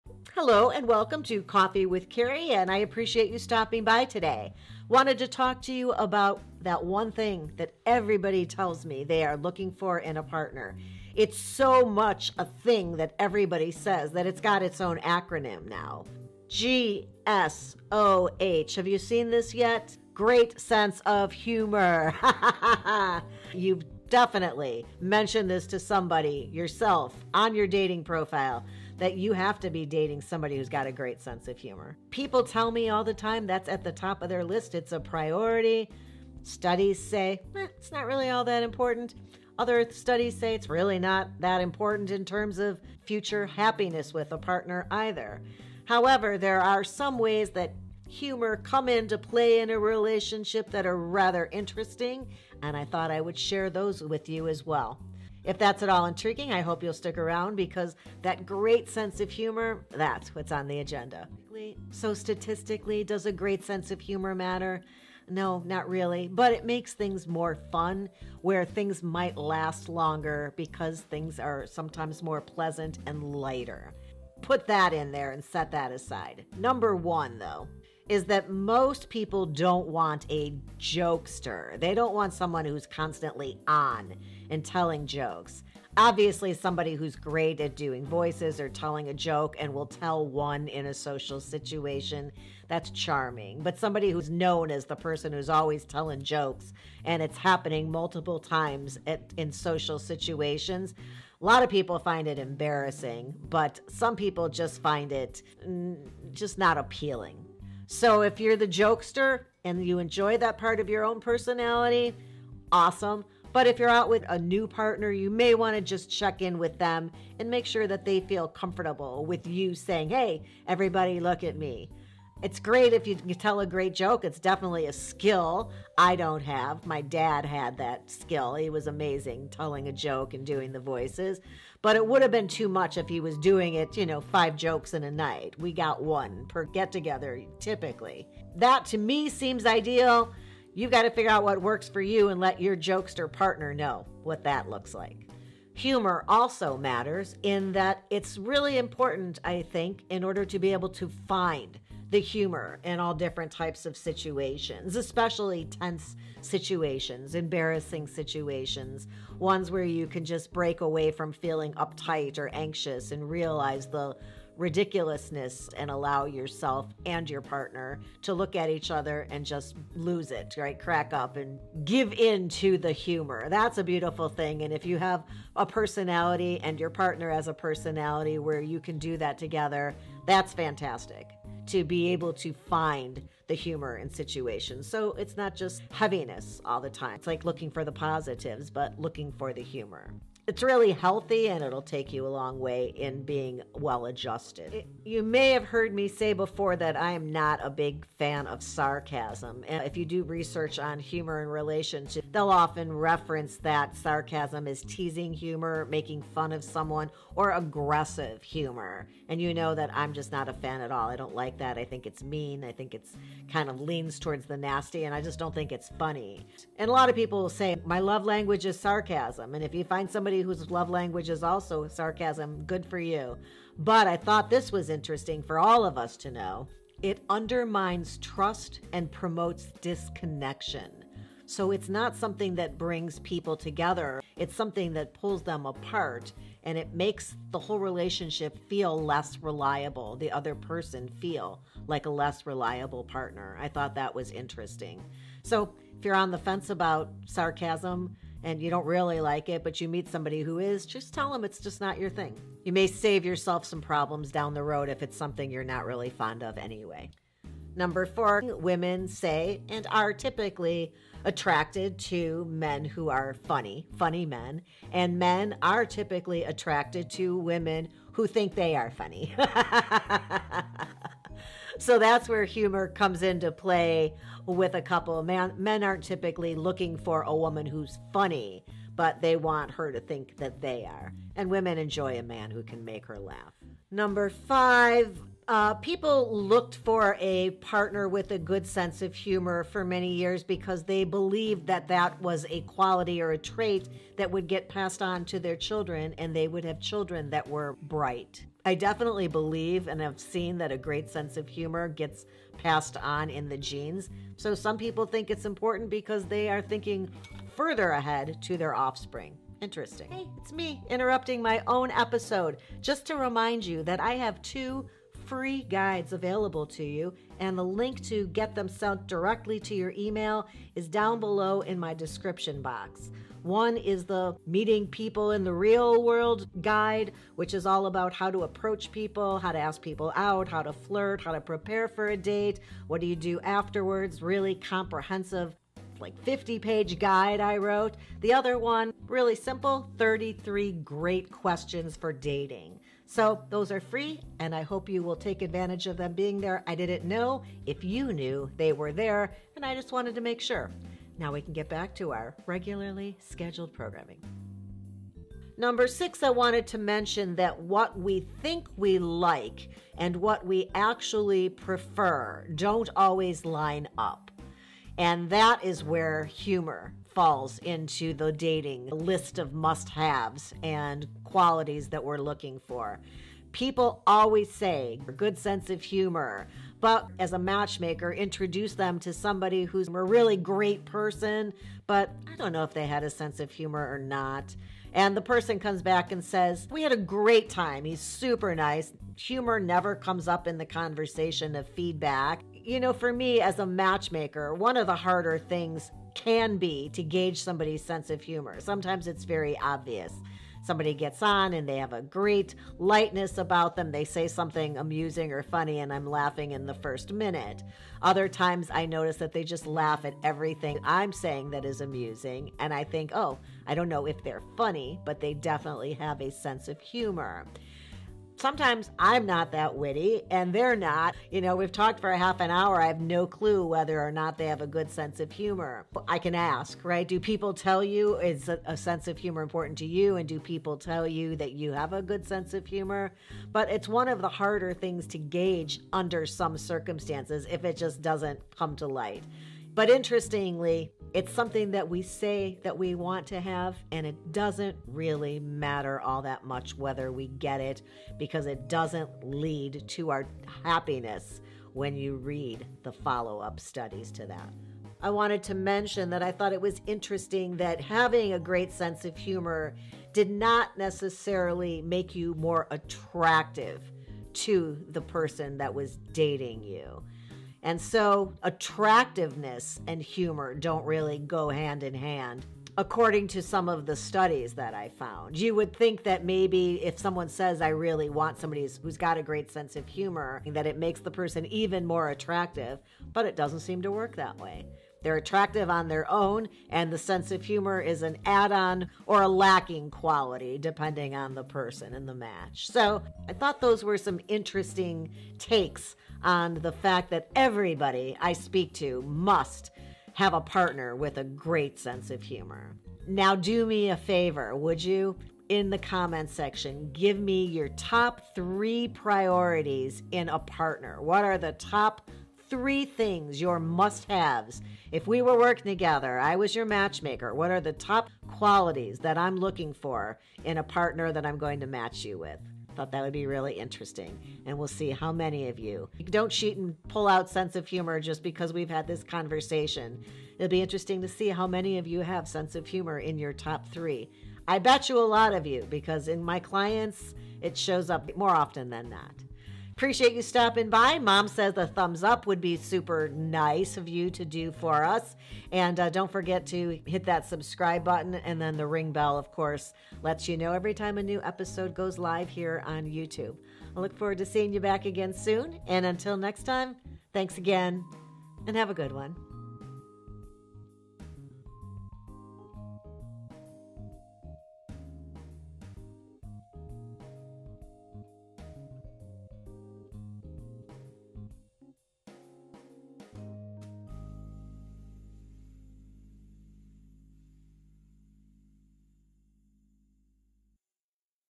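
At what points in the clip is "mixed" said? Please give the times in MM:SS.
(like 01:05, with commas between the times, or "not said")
not said.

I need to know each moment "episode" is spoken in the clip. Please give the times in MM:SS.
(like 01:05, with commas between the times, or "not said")
05:11, 09:11.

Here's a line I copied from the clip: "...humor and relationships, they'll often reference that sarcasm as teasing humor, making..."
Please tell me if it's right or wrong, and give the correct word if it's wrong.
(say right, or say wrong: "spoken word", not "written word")
right.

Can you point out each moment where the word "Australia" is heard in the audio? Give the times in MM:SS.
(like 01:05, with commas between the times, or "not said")
not said.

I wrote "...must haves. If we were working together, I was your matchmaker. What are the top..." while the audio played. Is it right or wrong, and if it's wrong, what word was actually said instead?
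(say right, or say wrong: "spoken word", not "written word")
right.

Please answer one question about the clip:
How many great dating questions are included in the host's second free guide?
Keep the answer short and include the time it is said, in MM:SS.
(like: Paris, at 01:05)
33, at 05:39.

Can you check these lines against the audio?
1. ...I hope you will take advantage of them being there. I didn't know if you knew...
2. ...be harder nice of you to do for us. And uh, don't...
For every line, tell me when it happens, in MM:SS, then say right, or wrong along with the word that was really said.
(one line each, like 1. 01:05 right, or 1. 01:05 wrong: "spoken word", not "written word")
1. 05:44 right
2. 09:02 wrong: "super", not "harder".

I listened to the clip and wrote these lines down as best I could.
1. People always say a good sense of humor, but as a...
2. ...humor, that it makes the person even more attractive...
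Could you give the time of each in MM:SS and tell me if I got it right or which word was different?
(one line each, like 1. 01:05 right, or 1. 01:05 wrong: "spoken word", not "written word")
1. 06:13 right
2. 07:59 right.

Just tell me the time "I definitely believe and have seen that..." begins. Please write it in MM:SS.
04:58.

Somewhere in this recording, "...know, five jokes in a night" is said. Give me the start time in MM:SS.
02:14.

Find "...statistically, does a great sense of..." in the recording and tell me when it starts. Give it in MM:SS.
01:02.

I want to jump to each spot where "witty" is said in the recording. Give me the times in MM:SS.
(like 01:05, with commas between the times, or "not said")
06:59.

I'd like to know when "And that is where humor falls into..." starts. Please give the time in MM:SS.
06:04.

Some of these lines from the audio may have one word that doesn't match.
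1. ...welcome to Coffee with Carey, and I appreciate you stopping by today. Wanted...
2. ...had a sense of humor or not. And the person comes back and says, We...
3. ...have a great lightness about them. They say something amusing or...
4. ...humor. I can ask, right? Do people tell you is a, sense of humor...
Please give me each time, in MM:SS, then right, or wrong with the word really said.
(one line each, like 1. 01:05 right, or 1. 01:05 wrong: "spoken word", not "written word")
1. 00:00 right
2. 06:22 right
3. 06:41 right
4. 07:05 right.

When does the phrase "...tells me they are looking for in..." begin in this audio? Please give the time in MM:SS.
00:08.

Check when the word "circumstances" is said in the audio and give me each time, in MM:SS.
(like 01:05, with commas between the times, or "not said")
07:16.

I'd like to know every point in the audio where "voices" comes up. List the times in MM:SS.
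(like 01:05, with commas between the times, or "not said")
01:28, 02:10.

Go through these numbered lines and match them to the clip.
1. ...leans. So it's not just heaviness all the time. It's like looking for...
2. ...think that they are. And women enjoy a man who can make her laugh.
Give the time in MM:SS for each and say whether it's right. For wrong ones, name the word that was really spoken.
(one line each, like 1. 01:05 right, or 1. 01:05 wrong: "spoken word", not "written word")
1. 03:04 wrong: "situations", not "leans"
2. 04:39 right.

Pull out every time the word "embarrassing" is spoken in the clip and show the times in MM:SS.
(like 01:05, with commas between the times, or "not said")
01:42, 02:37.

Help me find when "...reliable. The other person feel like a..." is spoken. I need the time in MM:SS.
03:59.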